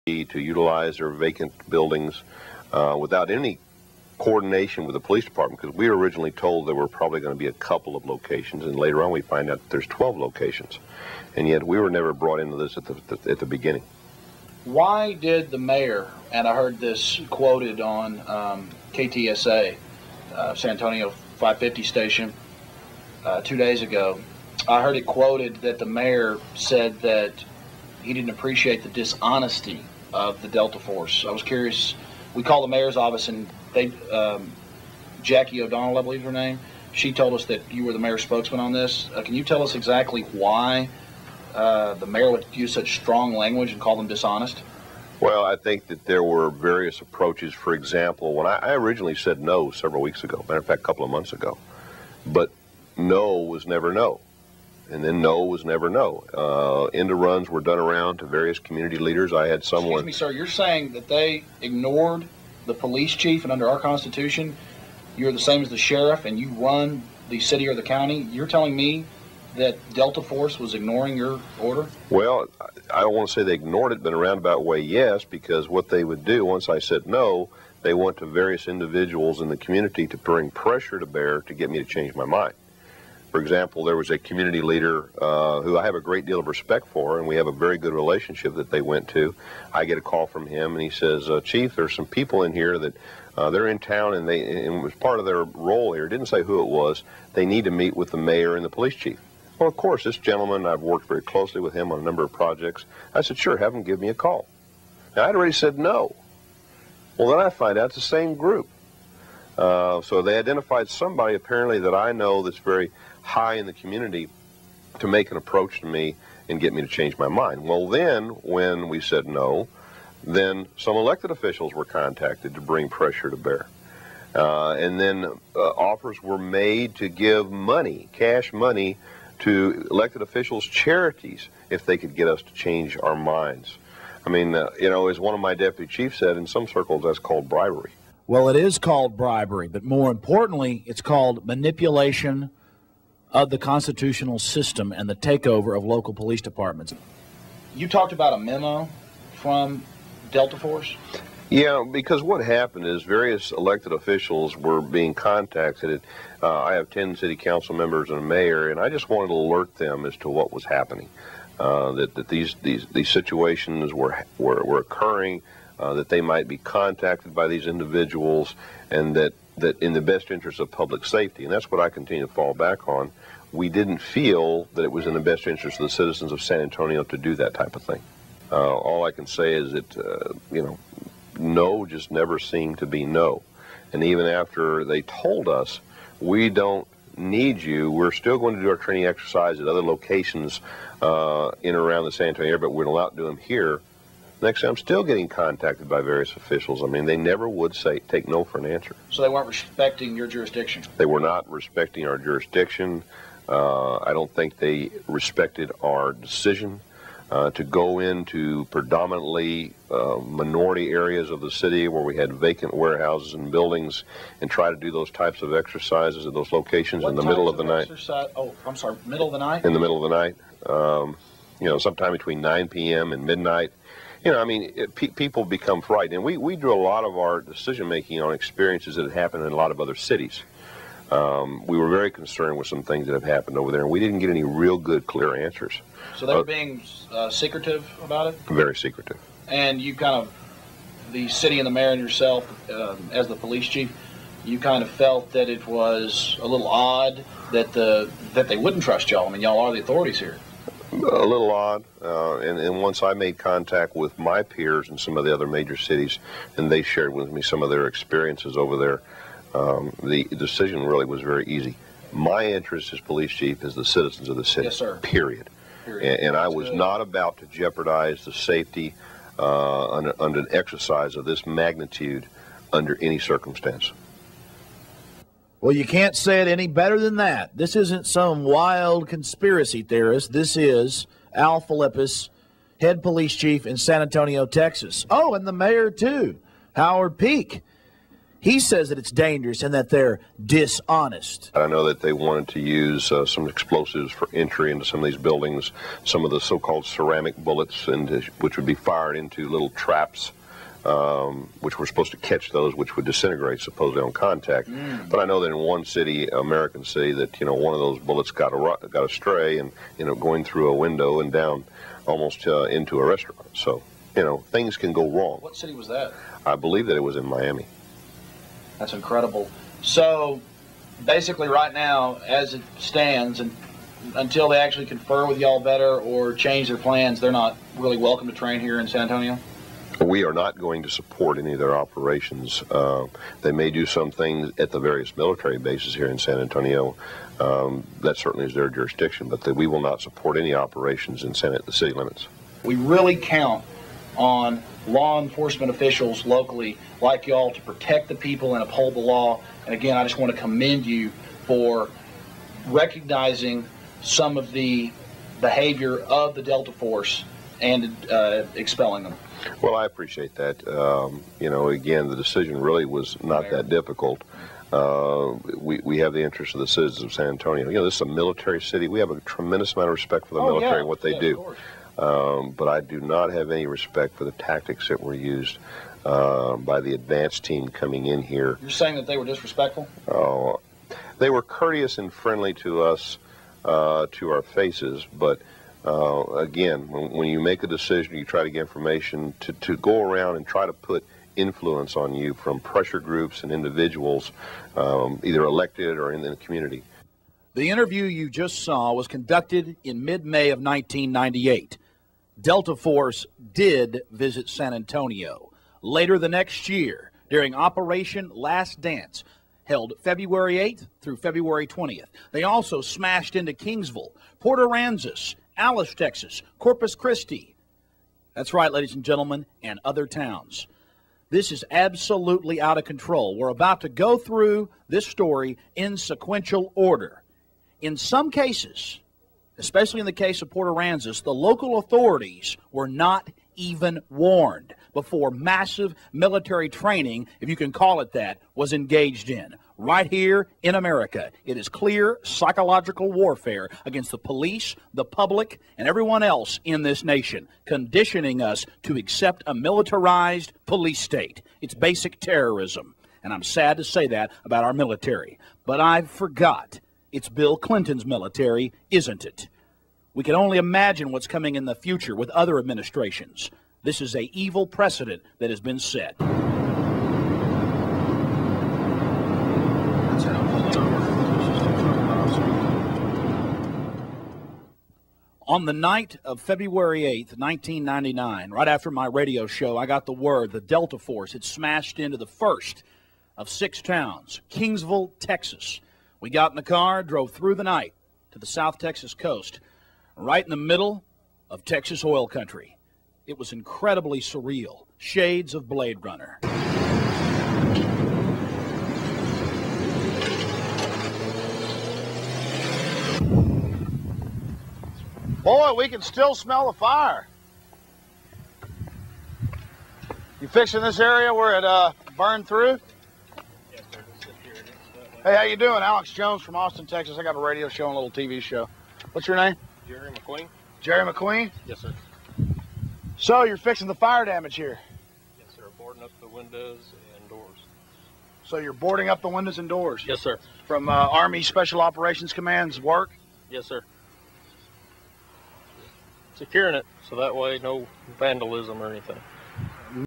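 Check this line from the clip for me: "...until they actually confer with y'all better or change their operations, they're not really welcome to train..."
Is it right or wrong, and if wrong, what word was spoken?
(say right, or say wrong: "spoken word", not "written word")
wrong: "plans", not "operations".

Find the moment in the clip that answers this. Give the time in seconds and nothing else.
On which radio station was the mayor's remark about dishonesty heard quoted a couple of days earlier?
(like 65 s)
18 s.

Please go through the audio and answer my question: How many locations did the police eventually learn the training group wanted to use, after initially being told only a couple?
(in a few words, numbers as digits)
12.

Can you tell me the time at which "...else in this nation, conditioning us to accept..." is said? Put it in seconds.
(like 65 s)
446 s.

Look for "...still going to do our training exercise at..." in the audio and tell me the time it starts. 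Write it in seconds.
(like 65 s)
188 s.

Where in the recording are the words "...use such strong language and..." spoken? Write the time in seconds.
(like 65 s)
42 s.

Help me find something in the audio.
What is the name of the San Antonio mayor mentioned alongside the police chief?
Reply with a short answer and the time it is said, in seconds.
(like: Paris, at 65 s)
Howard Peak, at 286 s.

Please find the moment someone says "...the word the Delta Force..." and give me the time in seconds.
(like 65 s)
480 s.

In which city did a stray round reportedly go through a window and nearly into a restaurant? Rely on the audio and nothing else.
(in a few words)
Miami.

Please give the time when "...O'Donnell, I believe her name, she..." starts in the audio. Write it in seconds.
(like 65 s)
35 s.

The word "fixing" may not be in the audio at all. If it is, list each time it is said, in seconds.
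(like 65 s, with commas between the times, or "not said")
510 s, 523 s.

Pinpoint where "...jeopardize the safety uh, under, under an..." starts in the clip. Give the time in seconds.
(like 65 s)
267 s.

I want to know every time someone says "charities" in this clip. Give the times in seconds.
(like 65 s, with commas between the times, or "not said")
130 s.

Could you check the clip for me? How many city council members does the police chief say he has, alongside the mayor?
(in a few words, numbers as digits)
10.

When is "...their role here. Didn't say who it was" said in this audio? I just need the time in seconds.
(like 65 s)
95 s.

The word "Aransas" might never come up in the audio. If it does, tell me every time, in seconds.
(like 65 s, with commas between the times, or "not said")
414 s, 430 s.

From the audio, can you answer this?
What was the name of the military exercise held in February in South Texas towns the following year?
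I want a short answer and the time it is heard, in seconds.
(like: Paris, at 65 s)
Operation Last Dance, at 407 s.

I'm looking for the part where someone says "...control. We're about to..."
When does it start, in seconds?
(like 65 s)
422 s.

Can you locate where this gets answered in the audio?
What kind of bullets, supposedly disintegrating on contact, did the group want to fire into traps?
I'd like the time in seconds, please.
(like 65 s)
296 s.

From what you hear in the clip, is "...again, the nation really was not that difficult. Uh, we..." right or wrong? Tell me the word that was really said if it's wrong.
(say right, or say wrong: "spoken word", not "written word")
wrong: "decision", not "nation".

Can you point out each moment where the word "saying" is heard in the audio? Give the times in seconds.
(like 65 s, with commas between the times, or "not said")
60 s, 378 s.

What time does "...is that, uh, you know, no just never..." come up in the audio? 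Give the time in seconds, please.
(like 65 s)
179 s.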